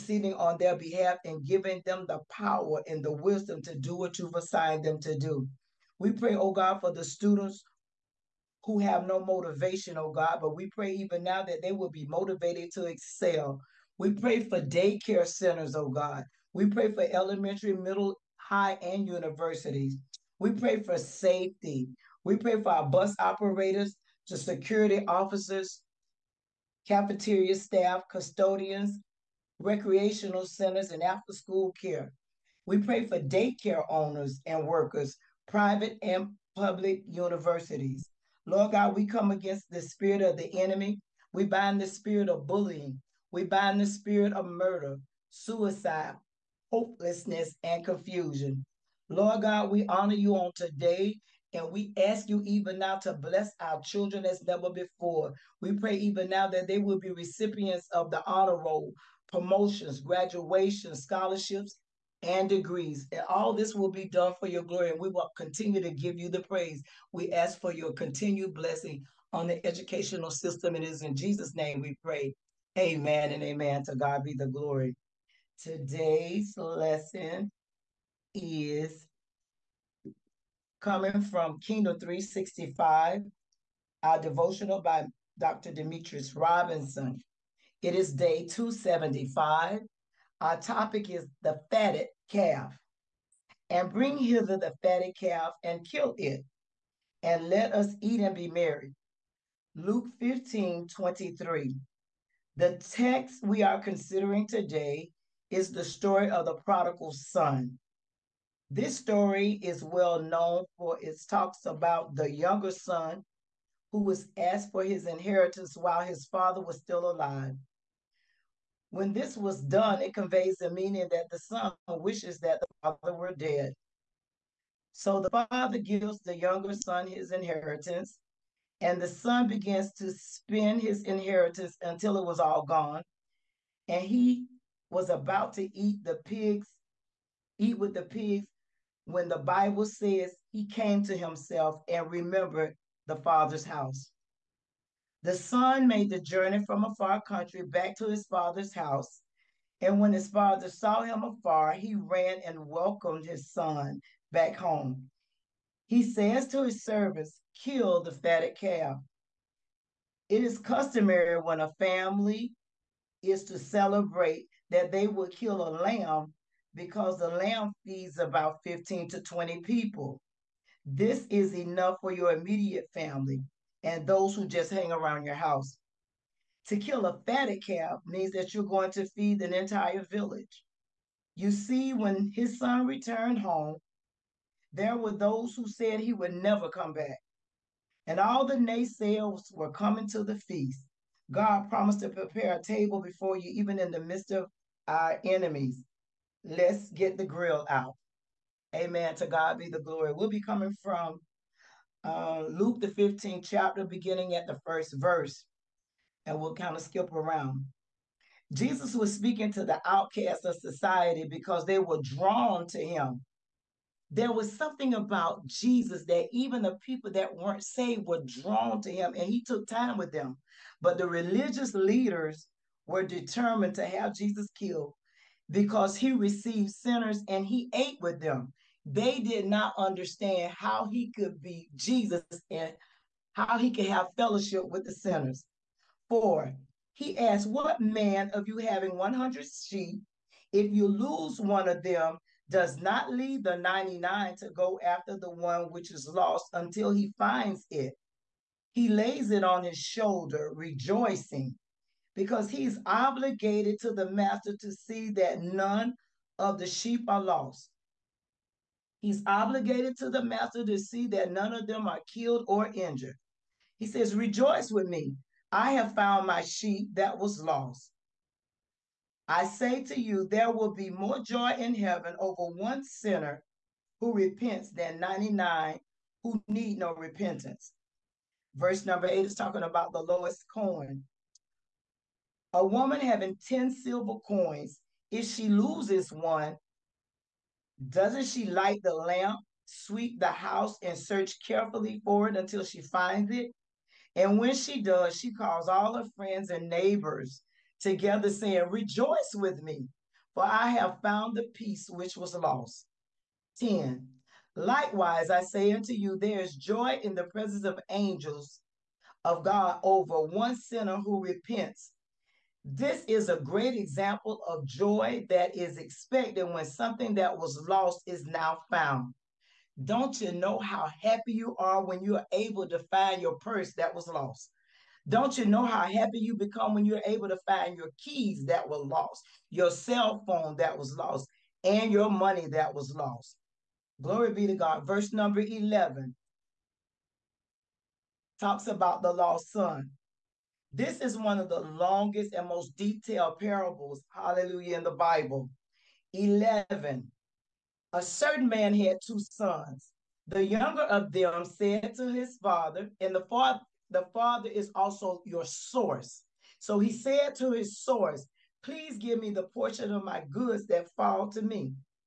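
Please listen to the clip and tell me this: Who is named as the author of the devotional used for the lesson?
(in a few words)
Dr. Demetrius Robinson.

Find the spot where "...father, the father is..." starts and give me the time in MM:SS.
05:53.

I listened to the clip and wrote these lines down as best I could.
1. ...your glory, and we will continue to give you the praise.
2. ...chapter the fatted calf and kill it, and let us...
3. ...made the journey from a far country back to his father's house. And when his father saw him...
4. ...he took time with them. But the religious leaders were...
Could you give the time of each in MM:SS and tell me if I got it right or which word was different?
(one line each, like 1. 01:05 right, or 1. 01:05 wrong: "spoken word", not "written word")
1. 01:04 right
2. 01:34 wrong: "hither", not "chapter"
3. 02:25 right
4. 03:39 right.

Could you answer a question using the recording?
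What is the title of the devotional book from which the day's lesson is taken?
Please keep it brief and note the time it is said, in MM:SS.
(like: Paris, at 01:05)
Kingdom 365, at 01:21.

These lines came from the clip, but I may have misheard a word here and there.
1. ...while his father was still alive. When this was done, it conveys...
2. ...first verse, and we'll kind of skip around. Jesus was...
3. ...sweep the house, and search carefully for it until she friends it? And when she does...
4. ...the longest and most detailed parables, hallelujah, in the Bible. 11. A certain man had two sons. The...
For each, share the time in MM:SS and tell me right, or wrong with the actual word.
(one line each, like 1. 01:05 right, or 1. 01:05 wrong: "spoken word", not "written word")
1. 01:55 right
2. 03:24 right
3. 04:49 wrong: "finds", not "friends"
4. 05:41 right.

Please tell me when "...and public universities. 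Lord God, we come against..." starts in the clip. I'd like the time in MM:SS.
00:36.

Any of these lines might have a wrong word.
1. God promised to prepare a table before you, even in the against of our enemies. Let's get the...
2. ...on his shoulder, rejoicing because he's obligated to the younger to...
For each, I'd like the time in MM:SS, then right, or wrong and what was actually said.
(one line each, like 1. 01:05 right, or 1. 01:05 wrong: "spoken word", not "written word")
1. 03:11 wrong: "midst", not "against"
2. 04:09 wrong: "master", not "younger".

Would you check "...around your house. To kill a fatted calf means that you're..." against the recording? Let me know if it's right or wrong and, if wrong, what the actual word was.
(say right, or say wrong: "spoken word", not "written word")
right.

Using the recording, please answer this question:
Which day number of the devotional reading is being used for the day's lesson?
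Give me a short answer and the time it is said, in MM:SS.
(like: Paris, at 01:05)
275, at 01:28.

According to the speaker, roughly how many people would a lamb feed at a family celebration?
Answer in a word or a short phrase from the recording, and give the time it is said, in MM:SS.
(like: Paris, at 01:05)
15 to 20, at 02:48.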